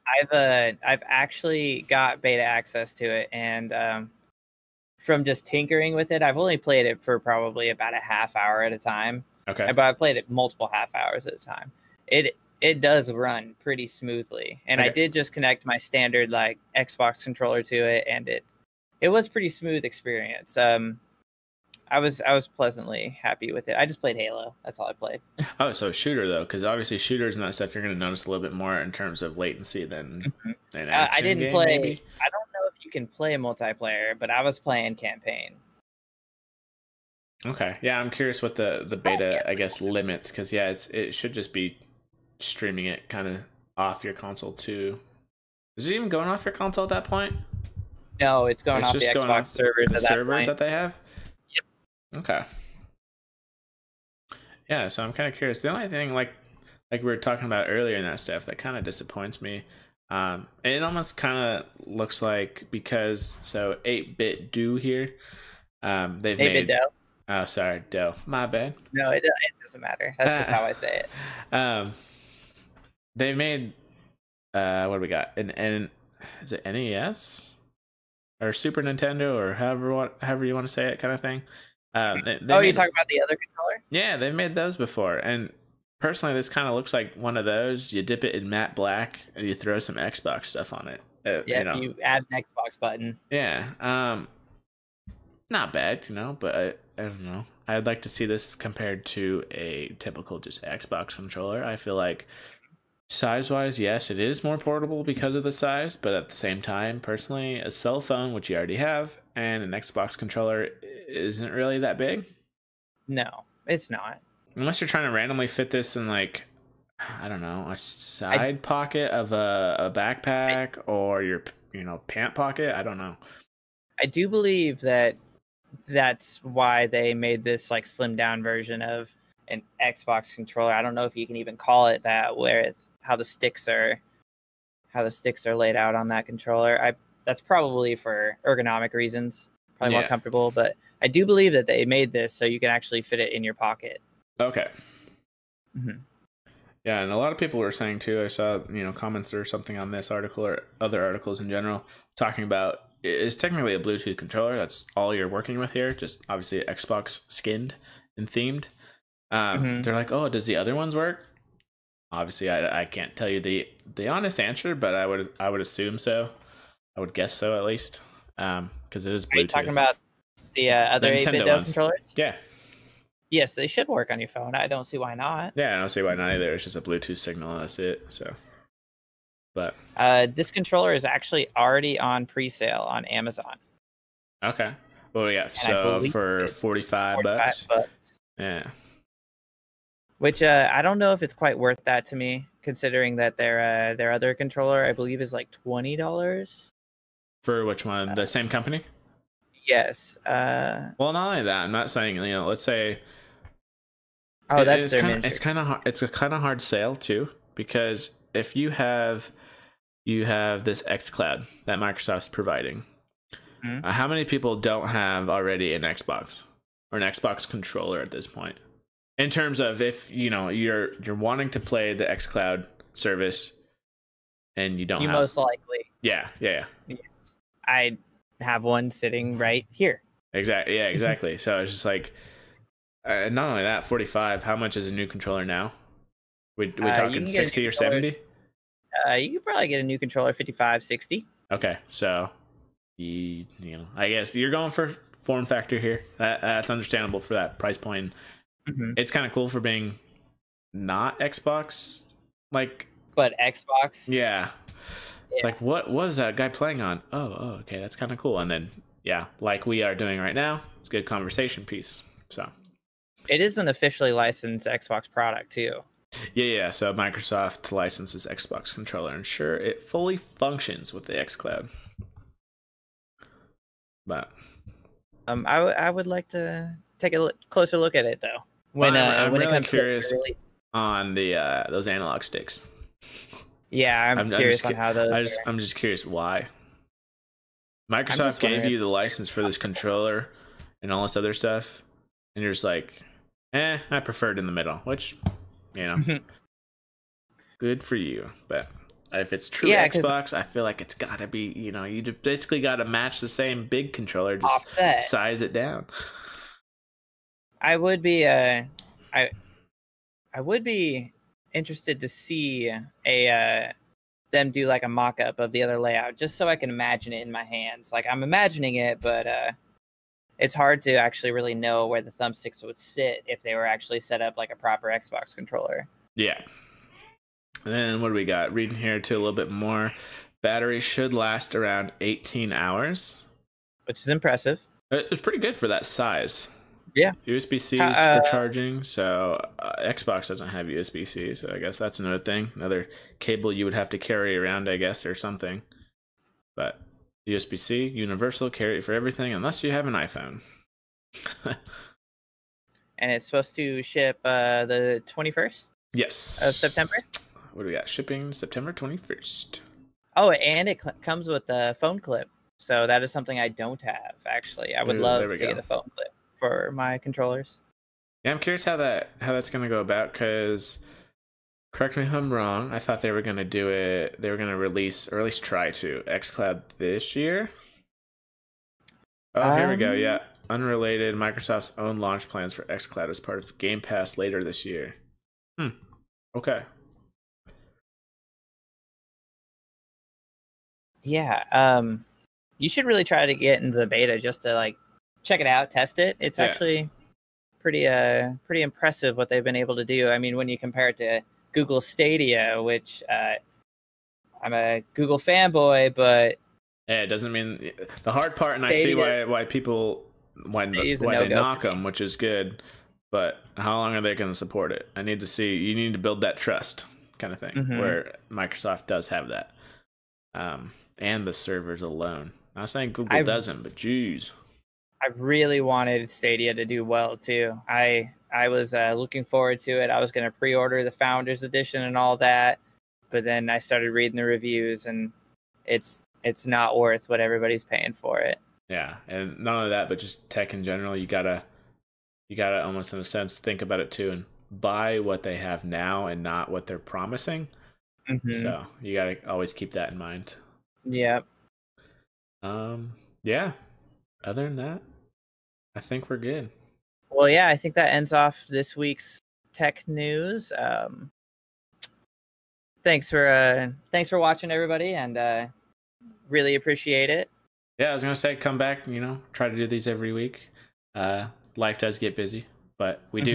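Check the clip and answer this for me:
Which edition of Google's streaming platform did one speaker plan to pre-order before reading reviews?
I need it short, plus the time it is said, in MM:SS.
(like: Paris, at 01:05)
Founders Edition, at 07:10.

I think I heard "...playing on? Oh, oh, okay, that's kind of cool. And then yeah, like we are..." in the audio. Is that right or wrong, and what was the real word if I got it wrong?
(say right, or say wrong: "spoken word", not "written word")
right.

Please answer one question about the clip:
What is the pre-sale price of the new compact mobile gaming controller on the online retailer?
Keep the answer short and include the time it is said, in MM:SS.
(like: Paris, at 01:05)
$45, at 03:06.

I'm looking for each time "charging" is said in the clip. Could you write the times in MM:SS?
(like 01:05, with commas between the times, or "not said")
05:38.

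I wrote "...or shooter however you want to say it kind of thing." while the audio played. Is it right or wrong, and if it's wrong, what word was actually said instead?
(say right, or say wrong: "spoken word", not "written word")
wrong: "however", not "shooter".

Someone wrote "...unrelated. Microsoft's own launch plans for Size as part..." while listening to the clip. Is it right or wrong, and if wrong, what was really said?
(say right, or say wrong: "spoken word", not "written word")
wrong: "XCloud", not "Size".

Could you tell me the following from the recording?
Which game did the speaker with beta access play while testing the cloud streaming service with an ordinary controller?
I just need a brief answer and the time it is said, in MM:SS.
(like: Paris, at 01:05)
Halo, at 00:24.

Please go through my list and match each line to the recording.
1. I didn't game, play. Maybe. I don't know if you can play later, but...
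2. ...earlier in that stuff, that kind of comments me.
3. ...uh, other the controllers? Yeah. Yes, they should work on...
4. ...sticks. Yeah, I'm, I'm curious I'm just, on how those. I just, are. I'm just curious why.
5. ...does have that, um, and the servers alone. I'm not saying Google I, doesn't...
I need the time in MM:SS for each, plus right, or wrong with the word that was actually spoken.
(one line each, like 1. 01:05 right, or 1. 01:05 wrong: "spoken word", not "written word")
1. 00:30 wrong: "multiplayer", not "later"
2. 00:57 wrong: "disappoints", not "comments"
3. 02:50 right
4. 04:42 right
5. 06:58 right.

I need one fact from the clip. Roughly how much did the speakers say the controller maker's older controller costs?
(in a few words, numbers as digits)
$20.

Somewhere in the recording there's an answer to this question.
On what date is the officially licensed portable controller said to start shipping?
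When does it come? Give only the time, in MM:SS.
05:58.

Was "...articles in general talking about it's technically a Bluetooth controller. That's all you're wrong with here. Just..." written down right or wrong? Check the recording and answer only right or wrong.
wrong.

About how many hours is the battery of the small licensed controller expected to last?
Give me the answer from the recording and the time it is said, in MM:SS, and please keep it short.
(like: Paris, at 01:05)
18 hours, at 05:32.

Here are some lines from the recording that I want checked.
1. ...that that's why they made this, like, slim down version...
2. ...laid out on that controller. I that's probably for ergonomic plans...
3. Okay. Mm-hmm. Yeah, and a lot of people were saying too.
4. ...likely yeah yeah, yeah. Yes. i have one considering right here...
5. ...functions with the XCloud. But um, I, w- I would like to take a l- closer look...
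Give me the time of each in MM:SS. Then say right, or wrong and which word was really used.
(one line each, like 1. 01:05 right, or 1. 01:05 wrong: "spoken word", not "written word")
1. 02:04 right
2. 02:15 wrong: "reasons", not "plans"
3. 02:24 right
4. 03:45 wrong: "sitting", not "considering"
5. 04:30 right.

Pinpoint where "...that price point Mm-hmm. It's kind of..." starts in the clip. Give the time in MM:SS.
04:07.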